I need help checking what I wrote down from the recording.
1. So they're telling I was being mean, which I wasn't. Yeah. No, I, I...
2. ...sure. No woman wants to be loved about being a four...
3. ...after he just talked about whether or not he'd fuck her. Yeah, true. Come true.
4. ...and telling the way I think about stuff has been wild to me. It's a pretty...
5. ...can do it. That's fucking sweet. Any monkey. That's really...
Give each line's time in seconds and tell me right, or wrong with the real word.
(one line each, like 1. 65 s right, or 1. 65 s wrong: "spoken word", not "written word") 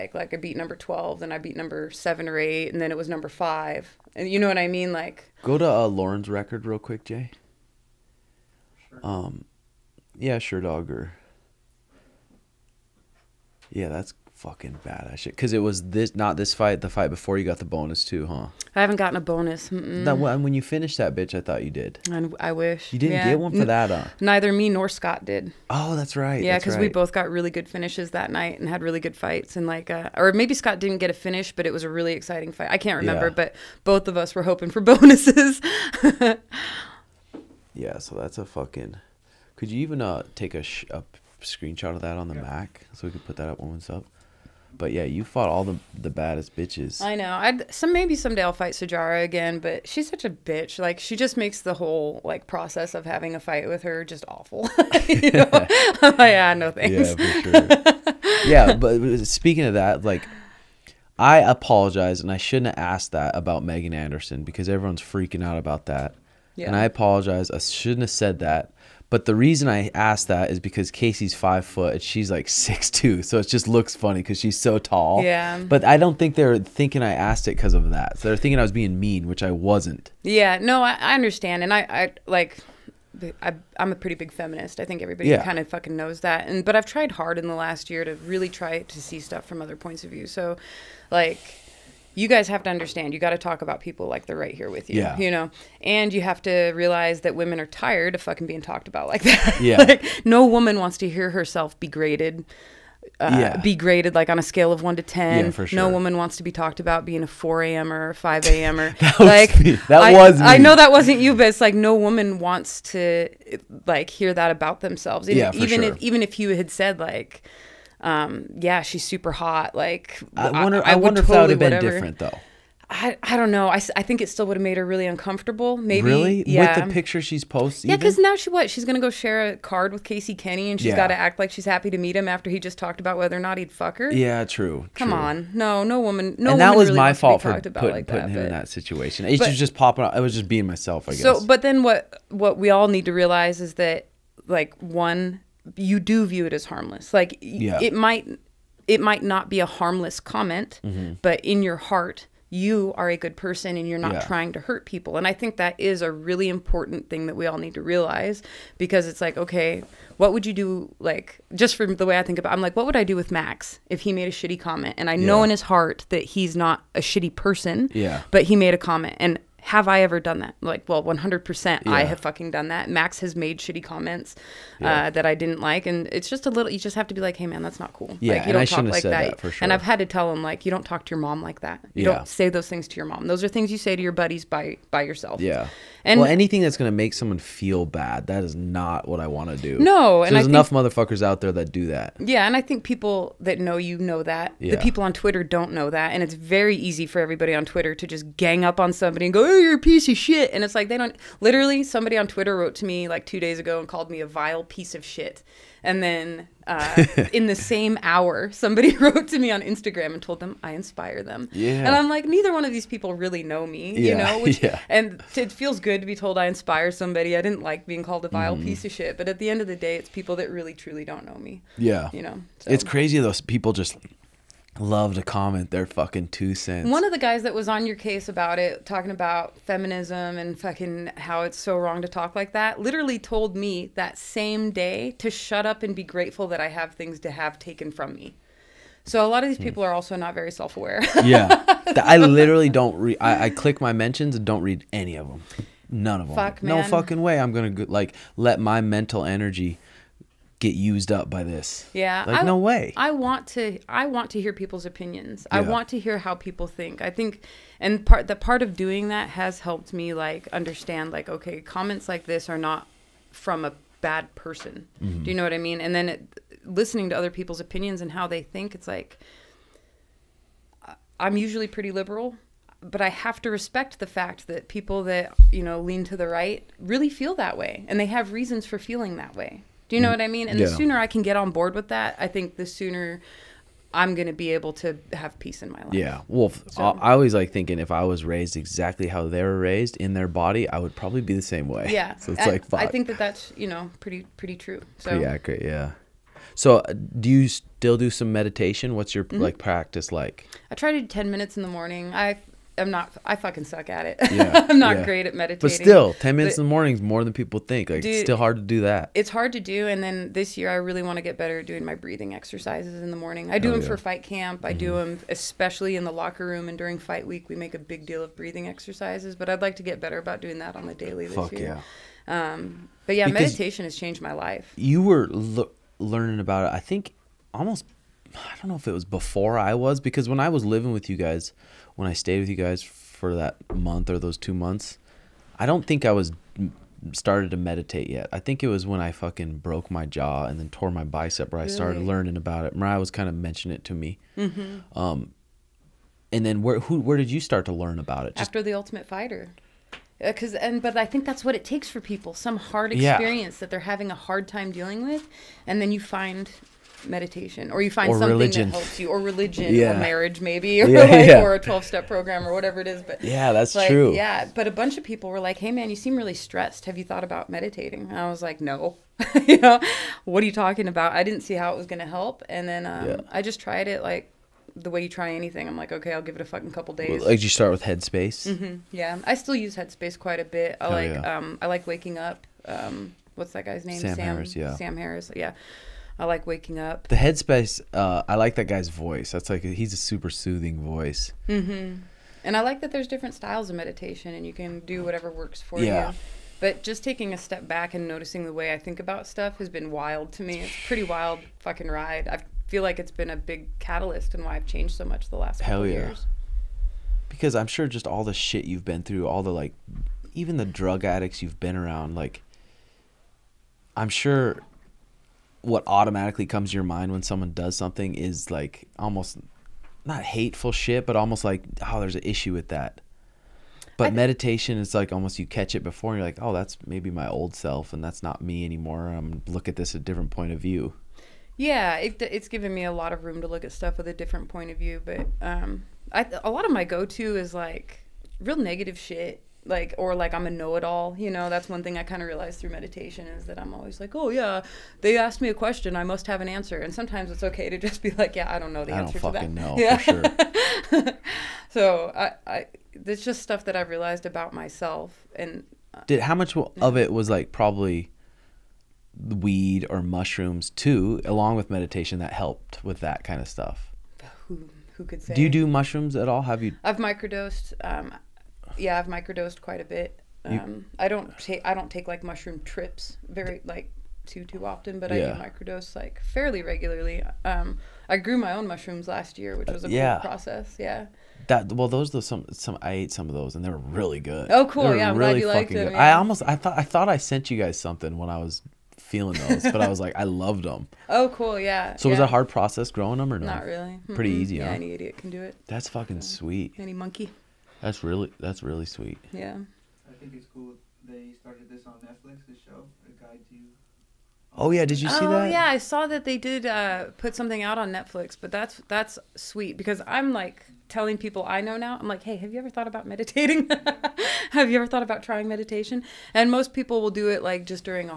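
1. 78 s wrong: "thinking", not "telling"
2. 105 s wrong: "talked", not "loved"
3. 132 s right
4. 397 s wrong: "noticing", not "telling"
5. 495 s right.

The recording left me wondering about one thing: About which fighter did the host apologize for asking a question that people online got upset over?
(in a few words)
Megan Anderson.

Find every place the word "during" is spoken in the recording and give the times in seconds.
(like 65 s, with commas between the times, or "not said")
316 s.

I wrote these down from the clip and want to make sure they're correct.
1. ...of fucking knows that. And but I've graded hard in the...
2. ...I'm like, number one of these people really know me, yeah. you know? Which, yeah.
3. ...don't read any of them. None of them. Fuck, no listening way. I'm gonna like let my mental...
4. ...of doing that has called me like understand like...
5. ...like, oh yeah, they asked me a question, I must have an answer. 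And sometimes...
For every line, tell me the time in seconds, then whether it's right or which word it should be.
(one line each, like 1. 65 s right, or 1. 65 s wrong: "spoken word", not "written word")
1. 85 s wrong: "tried", not "graded"
2. 211 s wrong: "neither", not "number"
3. 244 s wrong: "fucking", not "listening"
4. 258 s wrong: "helped", not "called"
5. 444 s right.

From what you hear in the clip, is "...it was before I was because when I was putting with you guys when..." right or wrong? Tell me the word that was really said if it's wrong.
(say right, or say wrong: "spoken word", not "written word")
wrong: "living", not "putting".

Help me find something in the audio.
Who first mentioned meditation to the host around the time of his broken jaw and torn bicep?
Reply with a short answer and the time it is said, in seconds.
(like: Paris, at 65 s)
Mariah, at 342 s.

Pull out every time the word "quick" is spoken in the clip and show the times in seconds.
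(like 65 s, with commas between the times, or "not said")
6 s.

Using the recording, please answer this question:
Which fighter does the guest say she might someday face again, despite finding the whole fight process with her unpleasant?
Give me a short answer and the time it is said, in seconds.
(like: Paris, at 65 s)
Sijara, at 48 s.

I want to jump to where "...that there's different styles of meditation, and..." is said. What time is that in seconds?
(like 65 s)
392 s.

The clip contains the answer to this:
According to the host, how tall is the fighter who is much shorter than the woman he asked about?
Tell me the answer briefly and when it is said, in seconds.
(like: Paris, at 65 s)
five foot, at 71 s.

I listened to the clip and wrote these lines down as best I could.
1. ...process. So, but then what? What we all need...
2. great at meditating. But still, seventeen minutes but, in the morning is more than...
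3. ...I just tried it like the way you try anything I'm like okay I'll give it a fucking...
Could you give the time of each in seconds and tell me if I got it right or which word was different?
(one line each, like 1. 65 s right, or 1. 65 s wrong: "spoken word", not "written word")
1. 141 s wrong: "guess", not "process"
2. 305 s wrong: "ten", not "seventeen"
3. 373 s right.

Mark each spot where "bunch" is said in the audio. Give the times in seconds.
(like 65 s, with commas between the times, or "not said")
364 s.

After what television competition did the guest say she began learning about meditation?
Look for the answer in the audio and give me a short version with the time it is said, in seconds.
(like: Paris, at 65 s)
The Ultimate Fighter, at 348 s.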